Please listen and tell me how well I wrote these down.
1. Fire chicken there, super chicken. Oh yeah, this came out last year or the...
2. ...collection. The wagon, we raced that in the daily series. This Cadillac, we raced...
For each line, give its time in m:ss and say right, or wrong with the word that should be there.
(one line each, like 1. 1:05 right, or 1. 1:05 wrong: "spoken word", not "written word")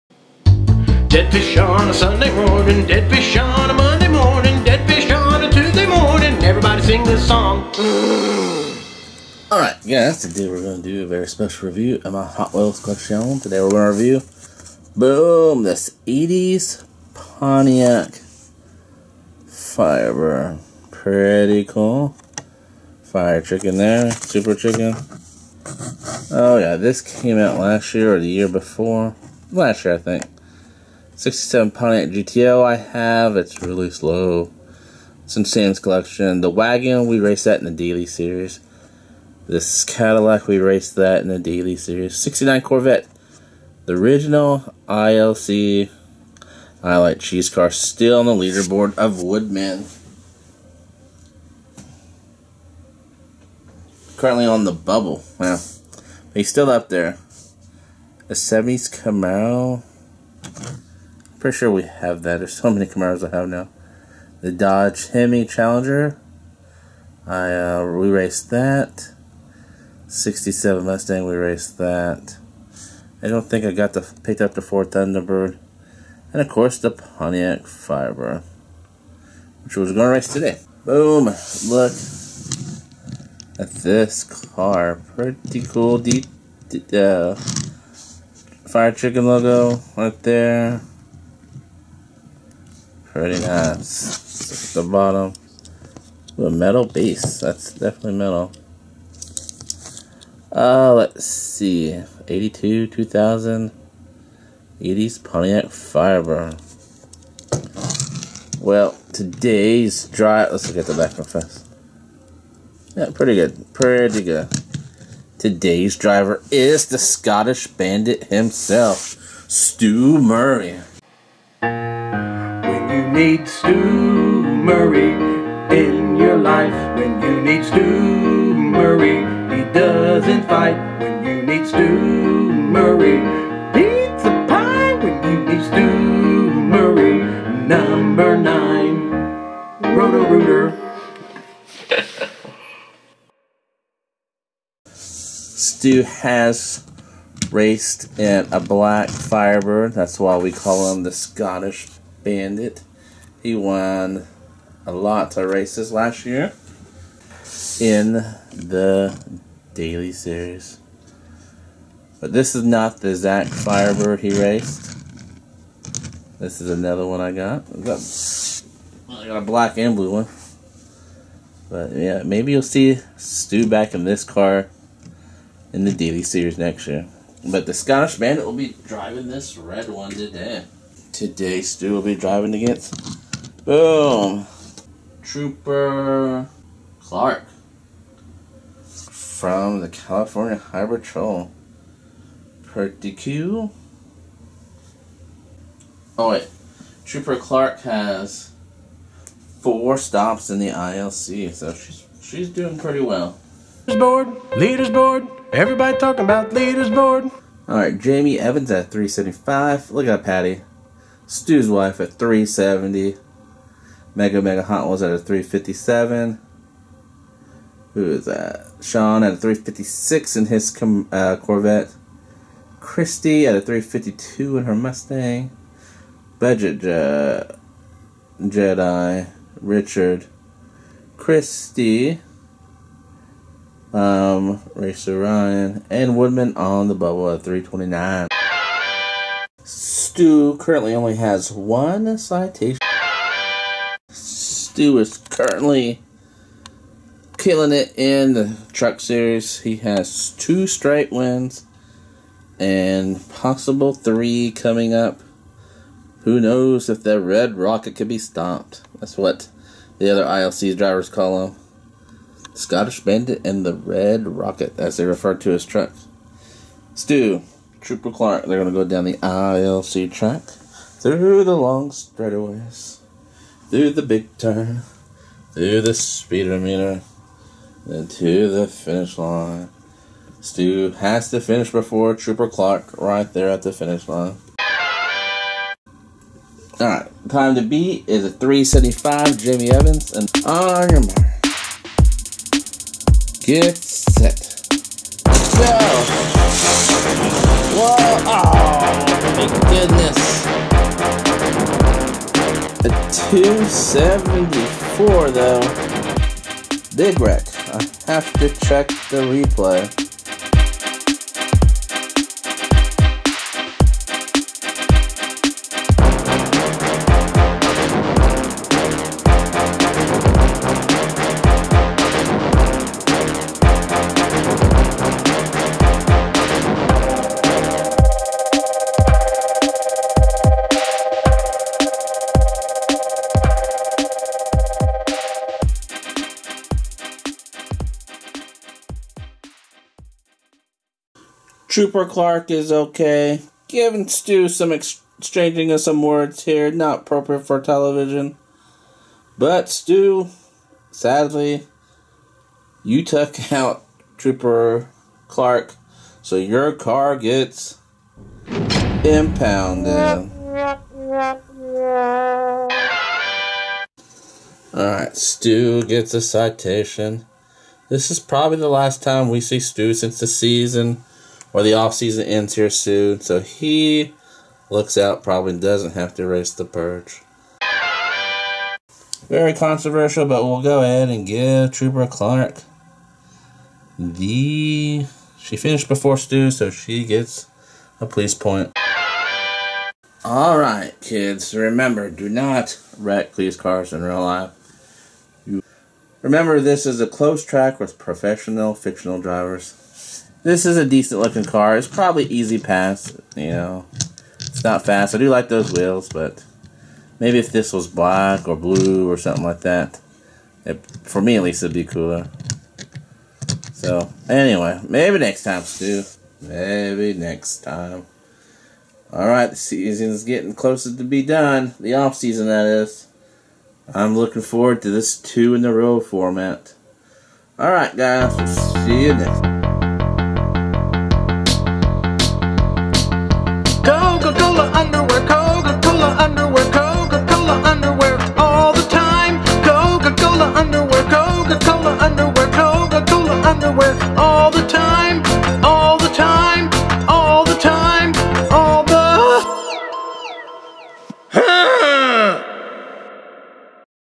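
1. 0:23 right
2. 0:35 right.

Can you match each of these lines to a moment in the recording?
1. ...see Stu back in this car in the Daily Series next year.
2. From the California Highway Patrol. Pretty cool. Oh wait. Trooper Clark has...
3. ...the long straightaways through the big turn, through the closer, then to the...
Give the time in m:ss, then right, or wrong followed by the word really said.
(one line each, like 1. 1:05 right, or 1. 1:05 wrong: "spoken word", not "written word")
1. 2:52 right
2. 3:08 right
3. 4:31 wrong: "speedometer", not "closer".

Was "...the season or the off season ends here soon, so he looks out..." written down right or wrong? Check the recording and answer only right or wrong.
right.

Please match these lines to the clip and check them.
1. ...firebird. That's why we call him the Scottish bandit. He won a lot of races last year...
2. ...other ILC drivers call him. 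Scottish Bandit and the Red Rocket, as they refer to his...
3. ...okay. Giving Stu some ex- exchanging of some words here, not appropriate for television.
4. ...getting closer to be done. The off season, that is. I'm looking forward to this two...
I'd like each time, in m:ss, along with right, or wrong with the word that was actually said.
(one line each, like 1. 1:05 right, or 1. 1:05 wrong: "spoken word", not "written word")
1. 2:29 right
2. 4:20 right
3. 5:42 right
4. 7:00 right.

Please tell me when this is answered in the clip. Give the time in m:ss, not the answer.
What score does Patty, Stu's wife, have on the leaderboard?
3:32.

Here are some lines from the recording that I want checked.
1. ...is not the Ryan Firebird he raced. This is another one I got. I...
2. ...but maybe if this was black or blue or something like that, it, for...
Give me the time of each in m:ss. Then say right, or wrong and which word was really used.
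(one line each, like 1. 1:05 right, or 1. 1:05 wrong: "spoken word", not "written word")
1. 2:42 wrong: "Zach", not "Ryan"
2. 6:46 right.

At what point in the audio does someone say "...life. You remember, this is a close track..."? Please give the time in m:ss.
6:34.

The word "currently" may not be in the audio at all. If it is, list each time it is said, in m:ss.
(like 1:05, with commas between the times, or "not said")
0:54, 4:00, 4:05.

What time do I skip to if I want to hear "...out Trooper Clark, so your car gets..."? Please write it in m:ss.
5:53.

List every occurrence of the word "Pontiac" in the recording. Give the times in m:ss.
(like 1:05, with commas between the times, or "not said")
0:17, 0:31, 1:16, 1:45.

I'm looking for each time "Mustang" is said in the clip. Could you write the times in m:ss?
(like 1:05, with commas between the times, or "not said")
1:10, 3:44.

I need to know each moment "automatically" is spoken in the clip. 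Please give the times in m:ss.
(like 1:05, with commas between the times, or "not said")
not said.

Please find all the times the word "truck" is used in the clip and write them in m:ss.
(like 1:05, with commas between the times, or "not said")
4:08, 4:25.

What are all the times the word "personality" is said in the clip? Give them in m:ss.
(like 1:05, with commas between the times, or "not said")
not said.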